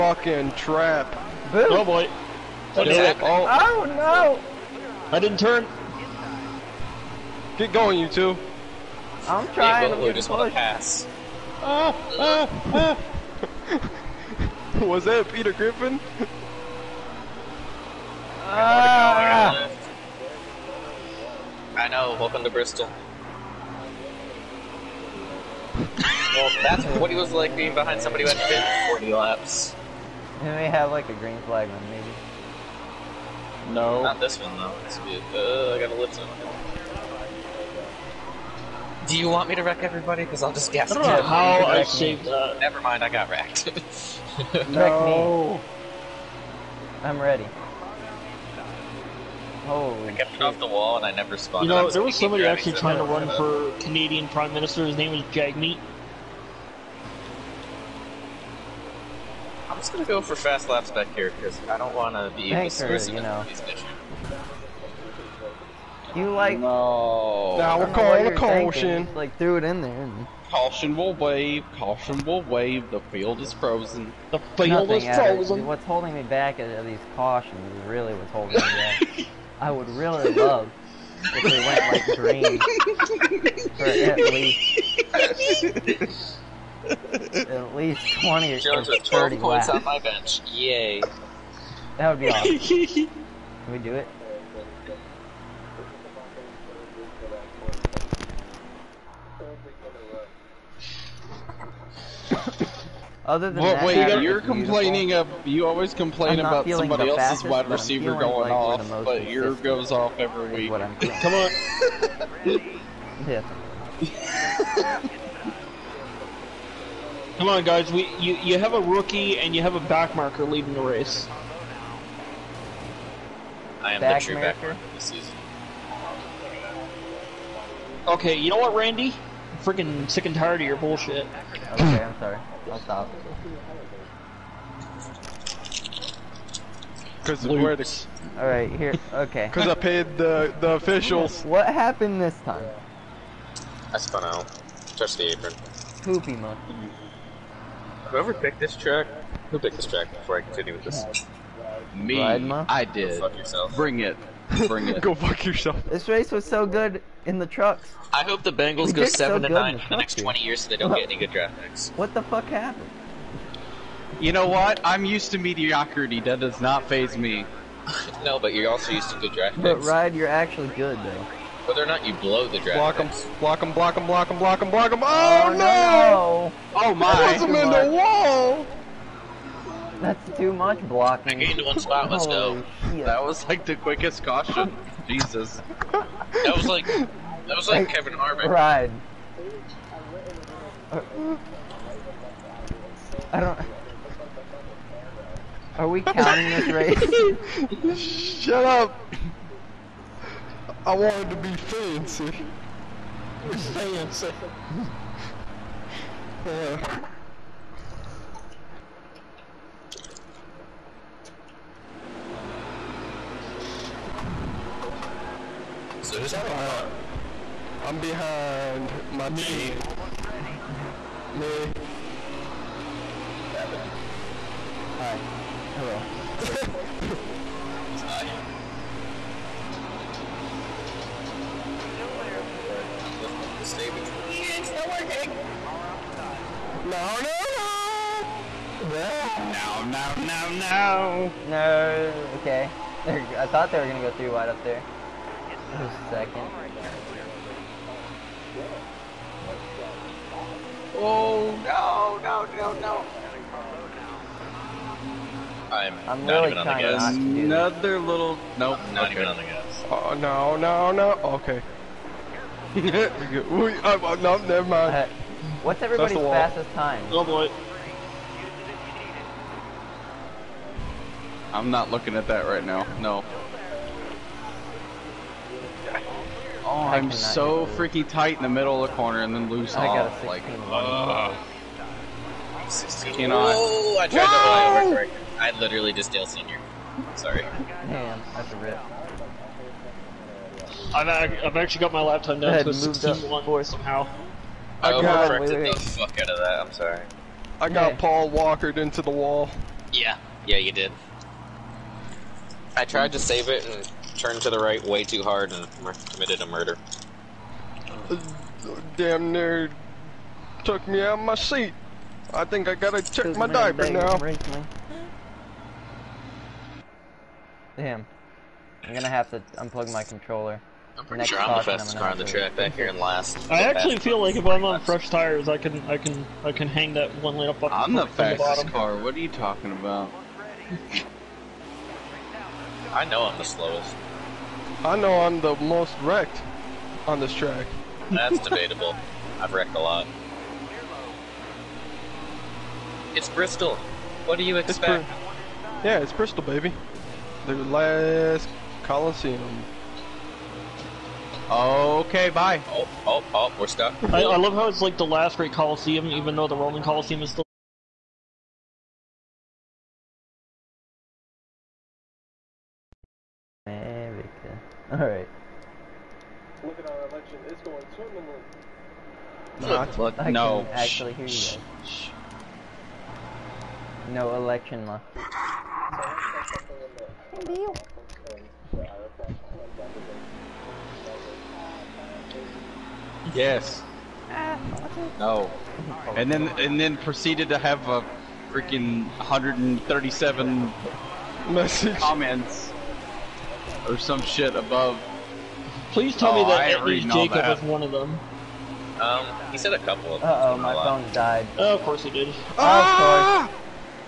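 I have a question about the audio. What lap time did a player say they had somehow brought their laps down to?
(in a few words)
16-1.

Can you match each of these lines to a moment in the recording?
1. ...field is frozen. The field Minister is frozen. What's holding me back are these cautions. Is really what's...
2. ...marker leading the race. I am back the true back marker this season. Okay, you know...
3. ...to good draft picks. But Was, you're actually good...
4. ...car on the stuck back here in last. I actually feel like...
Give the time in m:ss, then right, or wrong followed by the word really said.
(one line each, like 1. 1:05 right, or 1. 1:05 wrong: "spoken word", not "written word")
1. 1:13 wrong: "Nothing", not "Minister"
2. 2:00 right
3. 2:49 wrong: "Ryan", not "Was"
4. 5:21 wrong: "track", not "stuck".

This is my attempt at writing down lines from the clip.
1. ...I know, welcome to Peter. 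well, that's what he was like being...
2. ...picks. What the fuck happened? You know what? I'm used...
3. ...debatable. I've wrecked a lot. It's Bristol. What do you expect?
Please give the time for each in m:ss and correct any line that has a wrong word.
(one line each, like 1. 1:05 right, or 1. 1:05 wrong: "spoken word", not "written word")
1. 0:21 wrong: "Bristol", not "Peter"
2. 2:41 right
3. 5:38 right.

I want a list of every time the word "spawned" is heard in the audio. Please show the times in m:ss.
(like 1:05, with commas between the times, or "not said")
0:51.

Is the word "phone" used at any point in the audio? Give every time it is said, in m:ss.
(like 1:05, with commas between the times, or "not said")
6:40.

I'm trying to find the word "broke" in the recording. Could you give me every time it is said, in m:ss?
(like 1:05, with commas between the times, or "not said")
not said.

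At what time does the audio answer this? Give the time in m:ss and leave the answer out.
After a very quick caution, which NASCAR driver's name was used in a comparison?
3:07.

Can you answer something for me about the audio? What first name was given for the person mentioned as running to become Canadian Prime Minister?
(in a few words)
Jagmeet.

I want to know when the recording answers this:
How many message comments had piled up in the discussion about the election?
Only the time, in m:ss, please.
6:29.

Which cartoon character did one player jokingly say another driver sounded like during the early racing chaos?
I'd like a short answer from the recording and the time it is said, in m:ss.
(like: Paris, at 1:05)
Peter Griffin, at 0:15.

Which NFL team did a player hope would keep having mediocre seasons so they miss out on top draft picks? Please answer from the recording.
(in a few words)
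Bengals.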